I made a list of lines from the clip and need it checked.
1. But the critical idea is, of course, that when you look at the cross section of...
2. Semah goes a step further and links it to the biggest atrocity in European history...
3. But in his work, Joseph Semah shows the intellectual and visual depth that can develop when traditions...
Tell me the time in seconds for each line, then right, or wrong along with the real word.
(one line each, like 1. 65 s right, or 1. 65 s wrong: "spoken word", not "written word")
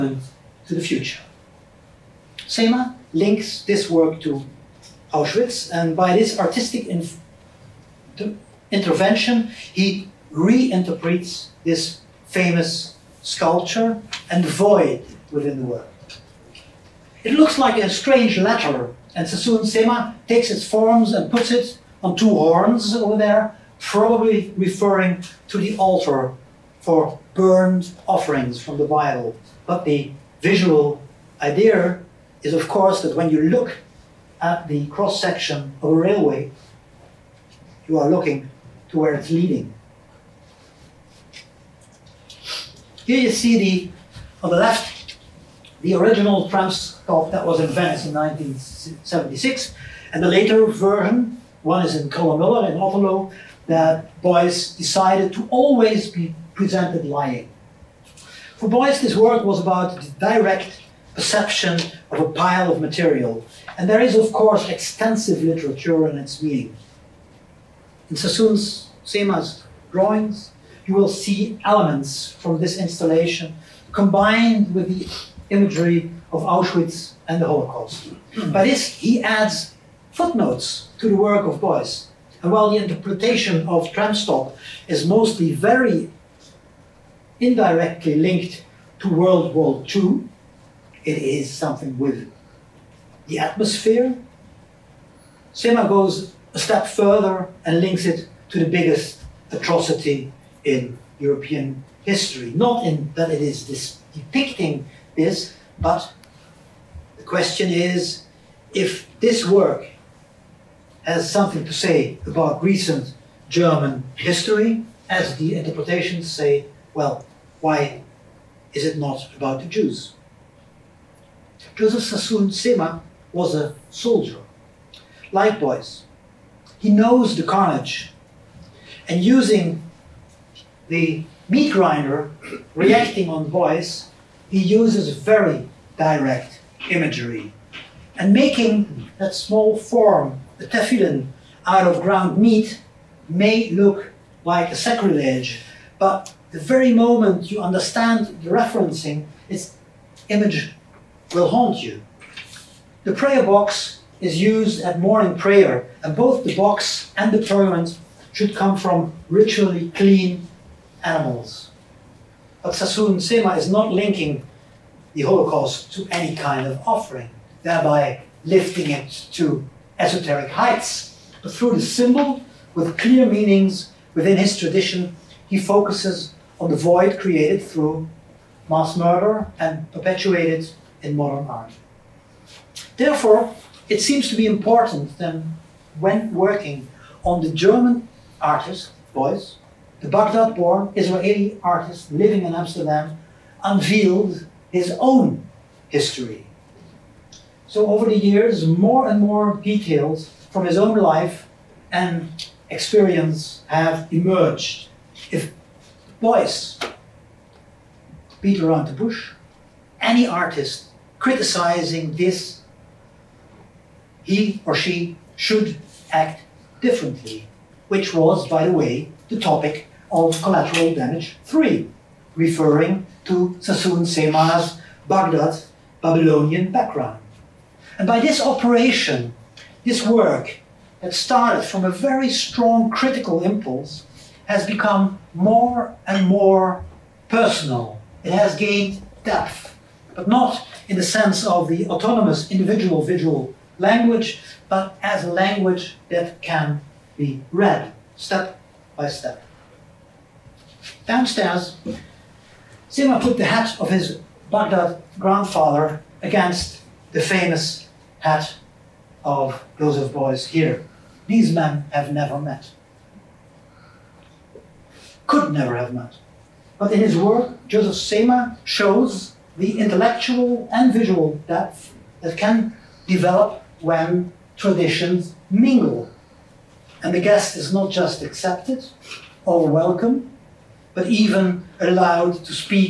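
1. 29 s wrong: "visual", not "critical"
2. 95 s right
3. 266 s right.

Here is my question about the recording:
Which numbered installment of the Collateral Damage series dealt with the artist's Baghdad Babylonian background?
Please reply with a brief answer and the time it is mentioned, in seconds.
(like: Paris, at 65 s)
Collateral Damage 3, at 220 s.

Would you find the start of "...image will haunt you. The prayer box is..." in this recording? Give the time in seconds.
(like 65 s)
150 s.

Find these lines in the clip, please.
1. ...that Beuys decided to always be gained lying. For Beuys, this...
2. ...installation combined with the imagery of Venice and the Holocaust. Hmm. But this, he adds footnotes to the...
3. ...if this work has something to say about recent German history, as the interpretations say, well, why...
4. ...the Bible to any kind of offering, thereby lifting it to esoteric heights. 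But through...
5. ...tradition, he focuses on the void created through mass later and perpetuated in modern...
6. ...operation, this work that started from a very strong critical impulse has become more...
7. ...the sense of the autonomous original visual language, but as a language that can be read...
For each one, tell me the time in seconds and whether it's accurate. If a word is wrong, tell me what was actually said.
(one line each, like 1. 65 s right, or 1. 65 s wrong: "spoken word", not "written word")
1. 53 s wrong: "presented", not "gained"
2. 72 s wrong: "Auschwitz", not "Venice"
3. 108 s right
4. 165 s wrong: "Holocaust", not "Bible"
5. 174 s wrong: "murder", not "later"
6. 228 s right
7. 240 s wrong: "individual", not "original".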